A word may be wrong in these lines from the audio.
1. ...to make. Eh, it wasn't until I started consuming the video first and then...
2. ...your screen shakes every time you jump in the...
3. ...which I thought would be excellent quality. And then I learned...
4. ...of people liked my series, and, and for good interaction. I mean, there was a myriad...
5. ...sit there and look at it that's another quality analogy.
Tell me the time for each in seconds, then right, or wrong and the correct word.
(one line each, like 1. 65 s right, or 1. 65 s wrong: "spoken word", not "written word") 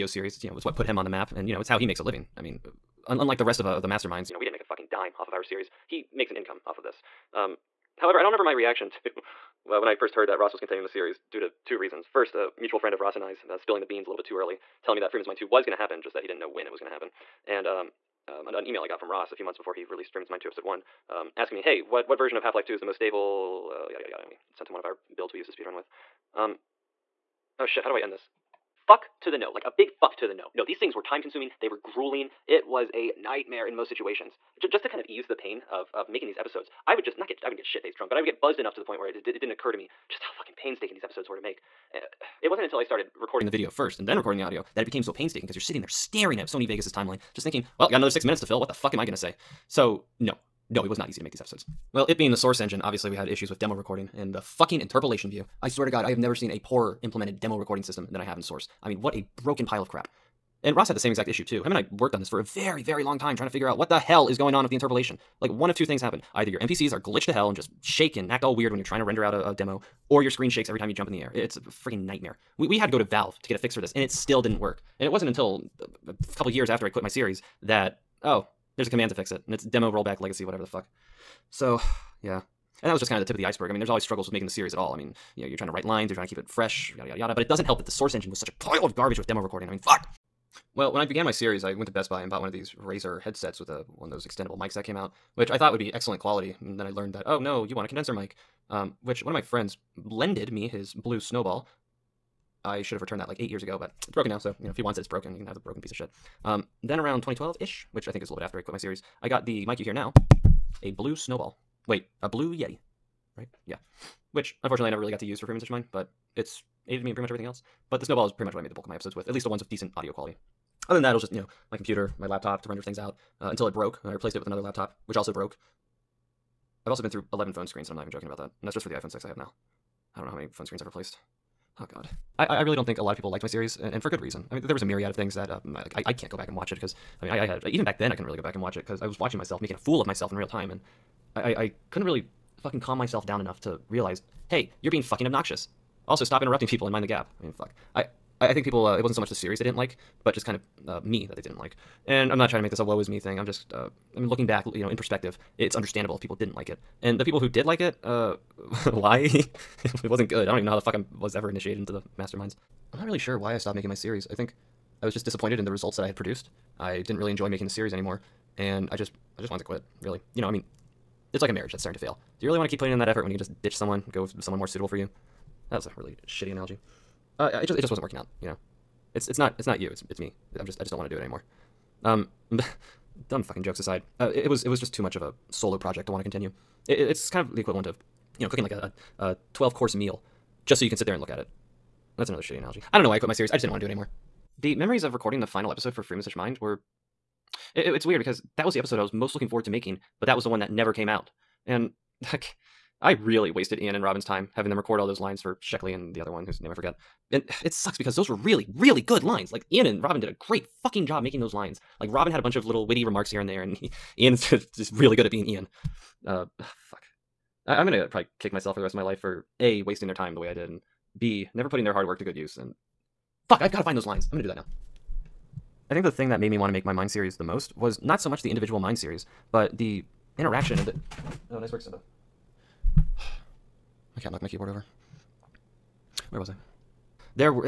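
1. 41 s wrong: "recording", not "consuming"
2. 70 s right
3. 95 s right
4. 133 s wrong: "reason", not "interaction"
5. 190 s wrong: "shitty", not "quality".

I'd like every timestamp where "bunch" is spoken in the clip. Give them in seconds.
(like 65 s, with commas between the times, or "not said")
212 s.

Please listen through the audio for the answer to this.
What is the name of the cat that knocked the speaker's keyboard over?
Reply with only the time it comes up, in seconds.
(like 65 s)
231 s.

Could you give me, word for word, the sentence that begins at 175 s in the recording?
That was a really shitty analogy.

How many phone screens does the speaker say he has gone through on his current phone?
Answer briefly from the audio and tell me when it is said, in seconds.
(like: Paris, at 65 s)
11, at 127 s.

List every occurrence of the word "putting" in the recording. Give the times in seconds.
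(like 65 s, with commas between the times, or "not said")
172 s, 221 s.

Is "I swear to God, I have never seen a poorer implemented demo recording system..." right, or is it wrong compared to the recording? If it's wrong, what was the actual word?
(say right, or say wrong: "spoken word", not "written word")
right.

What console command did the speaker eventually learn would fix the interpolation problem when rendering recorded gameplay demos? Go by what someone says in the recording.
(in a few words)
demo rollback legacy.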